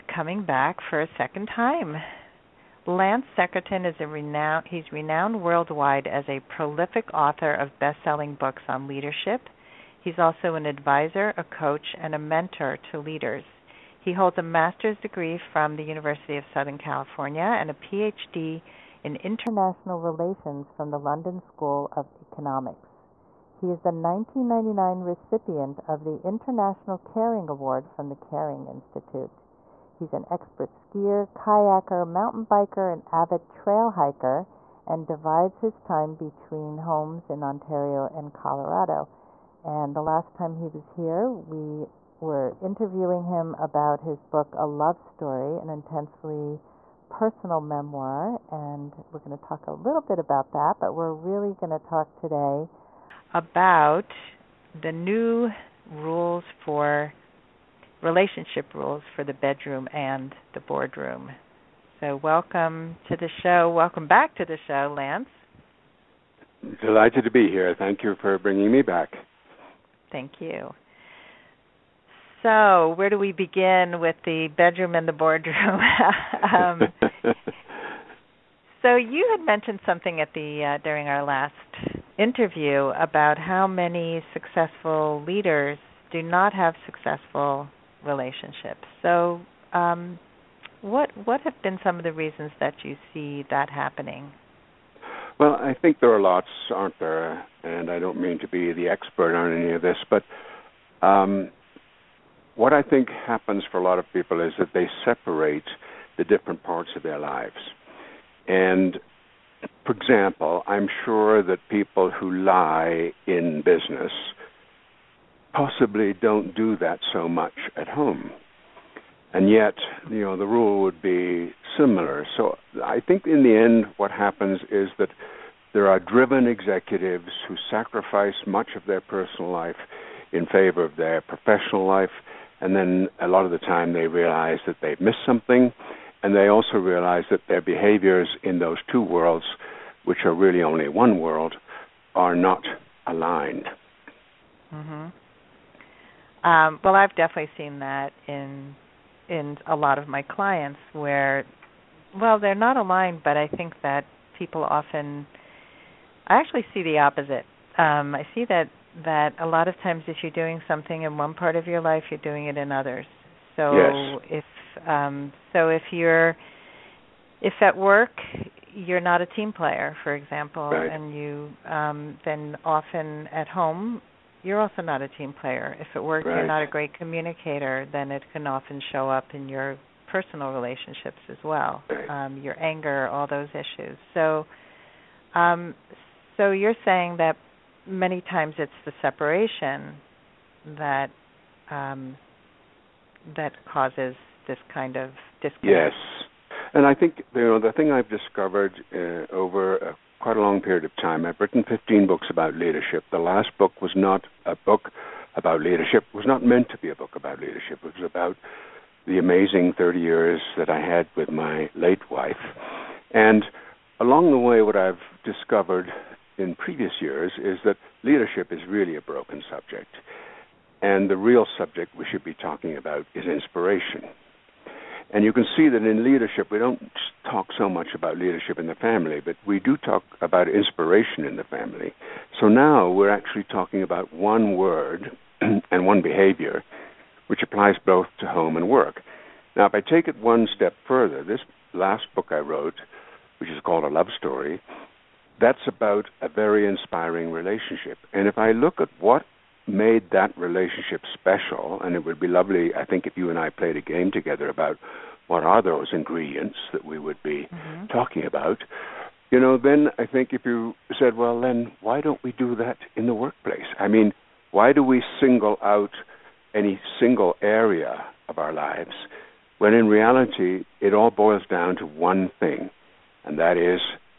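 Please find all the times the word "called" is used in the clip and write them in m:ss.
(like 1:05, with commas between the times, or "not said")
4:03.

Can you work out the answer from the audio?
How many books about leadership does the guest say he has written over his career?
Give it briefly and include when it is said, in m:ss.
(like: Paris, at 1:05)
15, at 3:21.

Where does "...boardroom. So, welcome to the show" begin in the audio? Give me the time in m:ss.
1:00.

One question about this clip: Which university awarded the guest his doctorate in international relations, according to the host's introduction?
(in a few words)
London School of Economics.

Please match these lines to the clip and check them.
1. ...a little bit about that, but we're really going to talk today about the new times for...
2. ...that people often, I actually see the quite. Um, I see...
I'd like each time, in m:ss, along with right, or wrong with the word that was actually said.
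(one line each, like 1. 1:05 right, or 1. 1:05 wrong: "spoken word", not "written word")
1. 0:49 wrong: "rules", not "times"
2. 2:33 wrong: "opposite", not "quite".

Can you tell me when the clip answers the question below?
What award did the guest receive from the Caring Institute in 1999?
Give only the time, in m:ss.
0:26.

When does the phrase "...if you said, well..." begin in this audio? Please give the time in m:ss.
4:20.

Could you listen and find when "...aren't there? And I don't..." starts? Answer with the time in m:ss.
1:36.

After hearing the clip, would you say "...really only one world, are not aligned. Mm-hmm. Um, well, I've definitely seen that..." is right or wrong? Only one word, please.
right.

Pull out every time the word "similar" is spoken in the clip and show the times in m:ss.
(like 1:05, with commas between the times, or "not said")
2:01.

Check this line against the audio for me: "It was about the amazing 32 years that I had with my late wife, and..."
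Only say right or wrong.
wrong.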